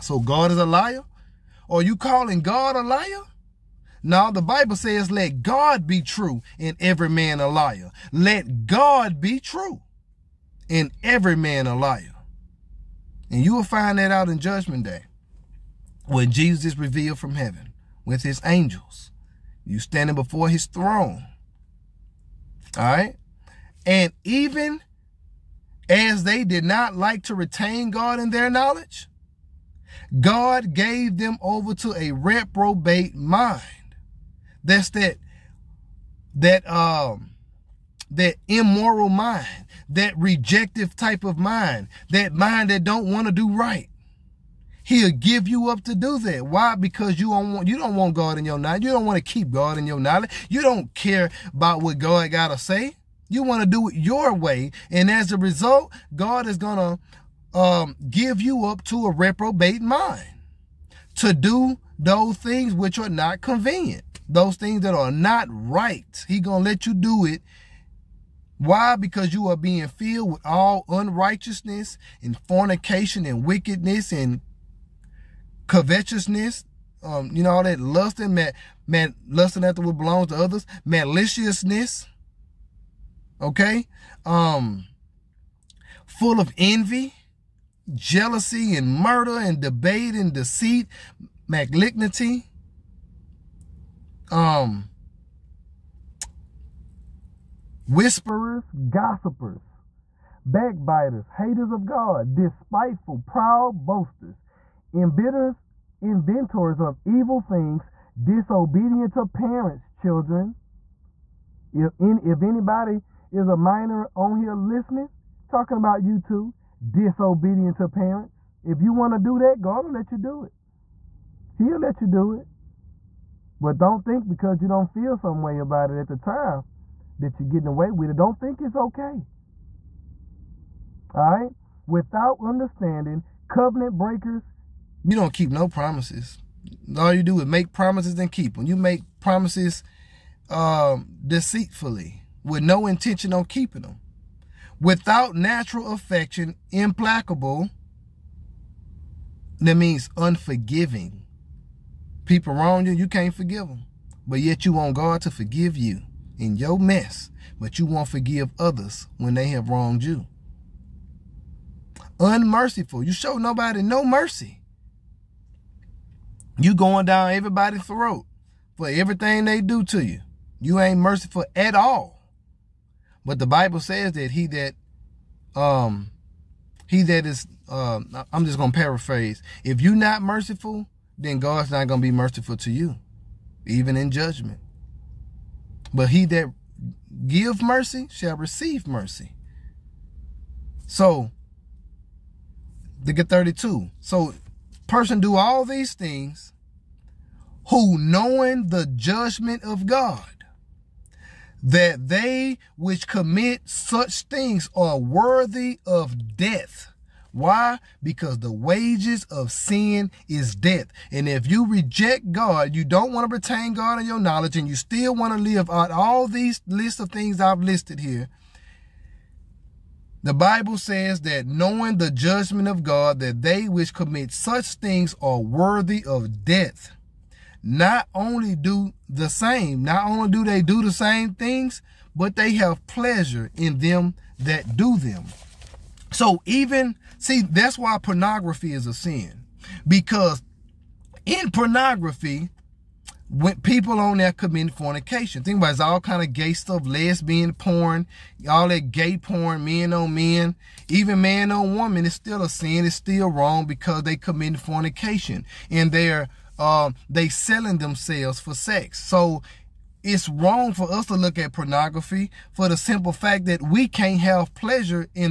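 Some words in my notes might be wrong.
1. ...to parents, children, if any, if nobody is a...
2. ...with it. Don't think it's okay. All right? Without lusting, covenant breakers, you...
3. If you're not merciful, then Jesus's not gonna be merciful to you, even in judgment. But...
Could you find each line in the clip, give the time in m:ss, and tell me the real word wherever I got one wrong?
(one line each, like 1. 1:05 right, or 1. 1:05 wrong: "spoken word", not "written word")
1. 1:49 wrong: "anybody", not "nobody"
2. 2:07 wrong: "understanding", not "lusting"
3. 2:59 wrong: "God", not "Jesus".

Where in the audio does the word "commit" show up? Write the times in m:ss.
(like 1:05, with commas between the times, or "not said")
3:23, 3:43, 4:04, 4:14.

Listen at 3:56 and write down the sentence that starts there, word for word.
So even, see, that's why pornography is a sin.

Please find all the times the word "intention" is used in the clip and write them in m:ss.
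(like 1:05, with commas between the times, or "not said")
2:22.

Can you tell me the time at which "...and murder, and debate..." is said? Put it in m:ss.
1:28.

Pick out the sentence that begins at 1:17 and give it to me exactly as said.
Um, you know, all that lusting, man, man, lusting after what belongs to others, maliciousness okay?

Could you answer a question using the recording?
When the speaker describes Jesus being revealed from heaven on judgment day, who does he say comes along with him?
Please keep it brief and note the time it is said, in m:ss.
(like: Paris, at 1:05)
his angels, at 0:18.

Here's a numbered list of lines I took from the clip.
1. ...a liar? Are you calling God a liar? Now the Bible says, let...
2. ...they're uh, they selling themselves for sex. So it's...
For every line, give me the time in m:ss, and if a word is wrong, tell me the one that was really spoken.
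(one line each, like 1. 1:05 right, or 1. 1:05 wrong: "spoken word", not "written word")
1. 0:00 right
2. 4:15 right.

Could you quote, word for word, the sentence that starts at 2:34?
But yet you want God to forgive you in your mess, but you won't forgive others when they have wronged you.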